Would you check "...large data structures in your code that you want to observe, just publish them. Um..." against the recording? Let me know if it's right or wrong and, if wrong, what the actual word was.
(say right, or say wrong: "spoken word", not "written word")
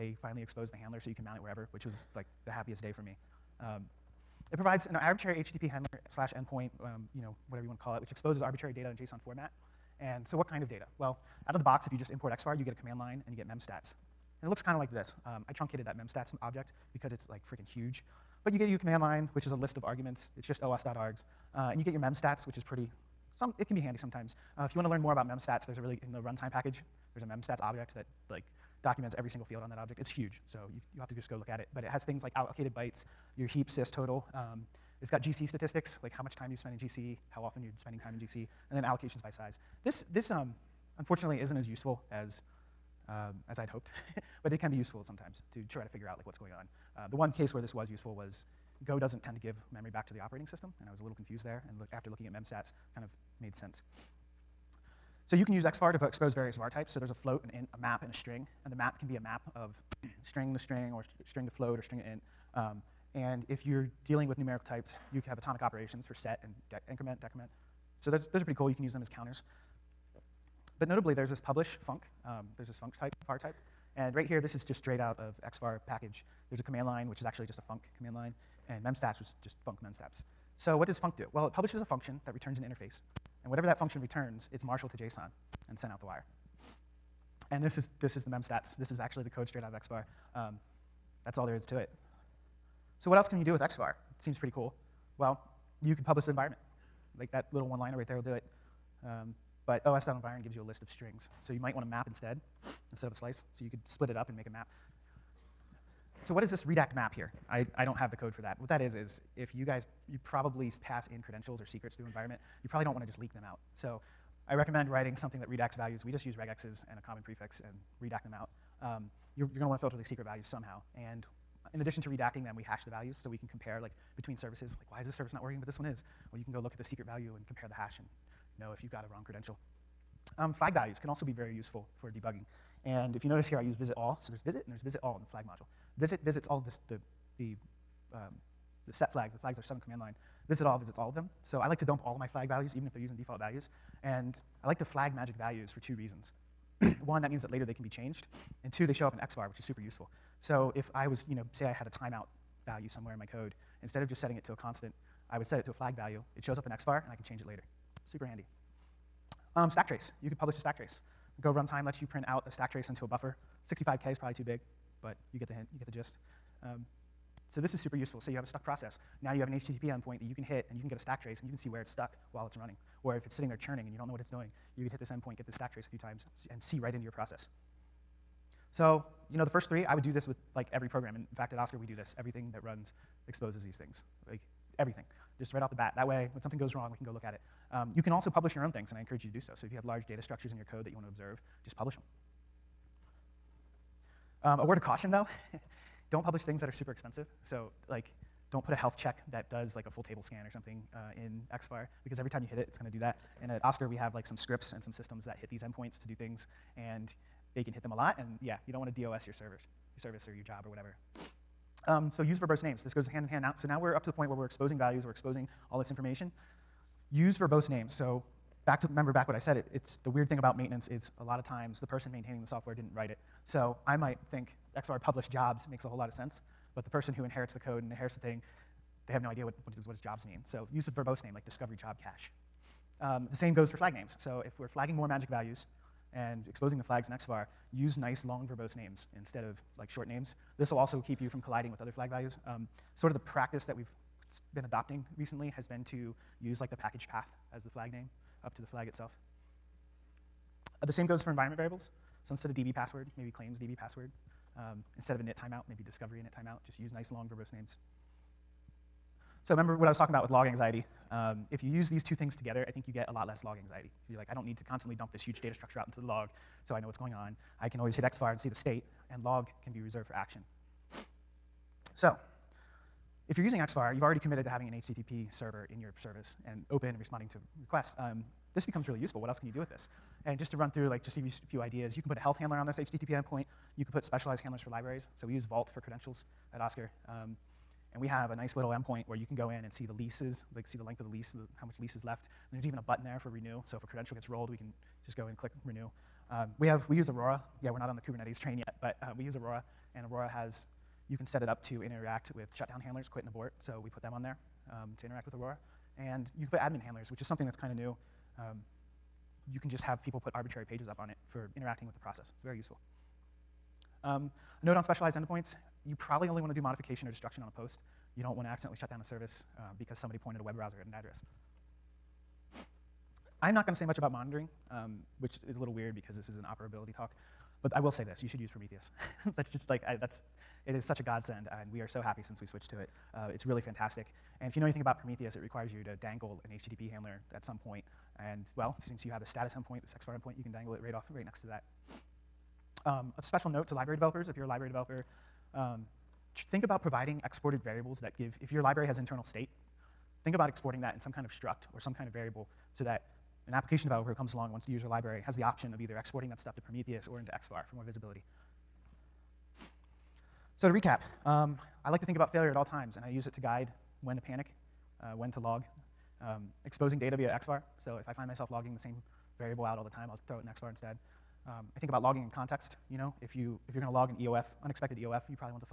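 right.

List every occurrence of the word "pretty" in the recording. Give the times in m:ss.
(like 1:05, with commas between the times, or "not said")
0:22, 1:08, 1:34.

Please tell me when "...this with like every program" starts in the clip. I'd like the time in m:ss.
3:00.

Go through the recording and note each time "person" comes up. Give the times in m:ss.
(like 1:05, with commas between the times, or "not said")
3:41, 3:46.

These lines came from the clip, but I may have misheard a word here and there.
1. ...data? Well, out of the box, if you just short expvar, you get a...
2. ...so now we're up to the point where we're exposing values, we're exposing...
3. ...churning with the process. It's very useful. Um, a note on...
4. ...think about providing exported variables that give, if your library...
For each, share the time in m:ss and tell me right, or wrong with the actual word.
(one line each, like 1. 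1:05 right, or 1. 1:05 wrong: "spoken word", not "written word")
1. 0:10 wrong: "import", not "short"
2. 3:33 right
3. 5:11 wrong: "interacting", not "churning"
4. 5:46 right.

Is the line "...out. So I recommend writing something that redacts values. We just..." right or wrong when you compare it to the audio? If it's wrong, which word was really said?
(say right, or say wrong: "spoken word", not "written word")
right.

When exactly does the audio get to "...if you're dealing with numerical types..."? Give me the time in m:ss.
1:03.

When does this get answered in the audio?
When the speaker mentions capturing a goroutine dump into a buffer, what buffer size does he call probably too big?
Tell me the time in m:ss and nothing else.
2:43.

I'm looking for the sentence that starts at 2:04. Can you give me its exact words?
Like, why is this service not working, but this one is?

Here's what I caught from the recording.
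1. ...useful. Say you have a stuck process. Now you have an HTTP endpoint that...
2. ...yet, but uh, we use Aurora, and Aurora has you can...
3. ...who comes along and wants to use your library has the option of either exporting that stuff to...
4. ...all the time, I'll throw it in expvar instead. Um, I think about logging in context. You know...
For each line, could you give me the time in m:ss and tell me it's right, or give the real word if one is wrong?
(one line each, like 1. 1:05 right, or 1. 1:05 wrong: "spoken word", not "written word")
1. 2:47 right
2. 4:58 right
3. 5:54 right
4. 6:09 right.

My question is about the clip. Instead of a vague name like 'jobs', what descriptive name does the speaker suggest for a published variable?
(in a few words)
discovery job cache.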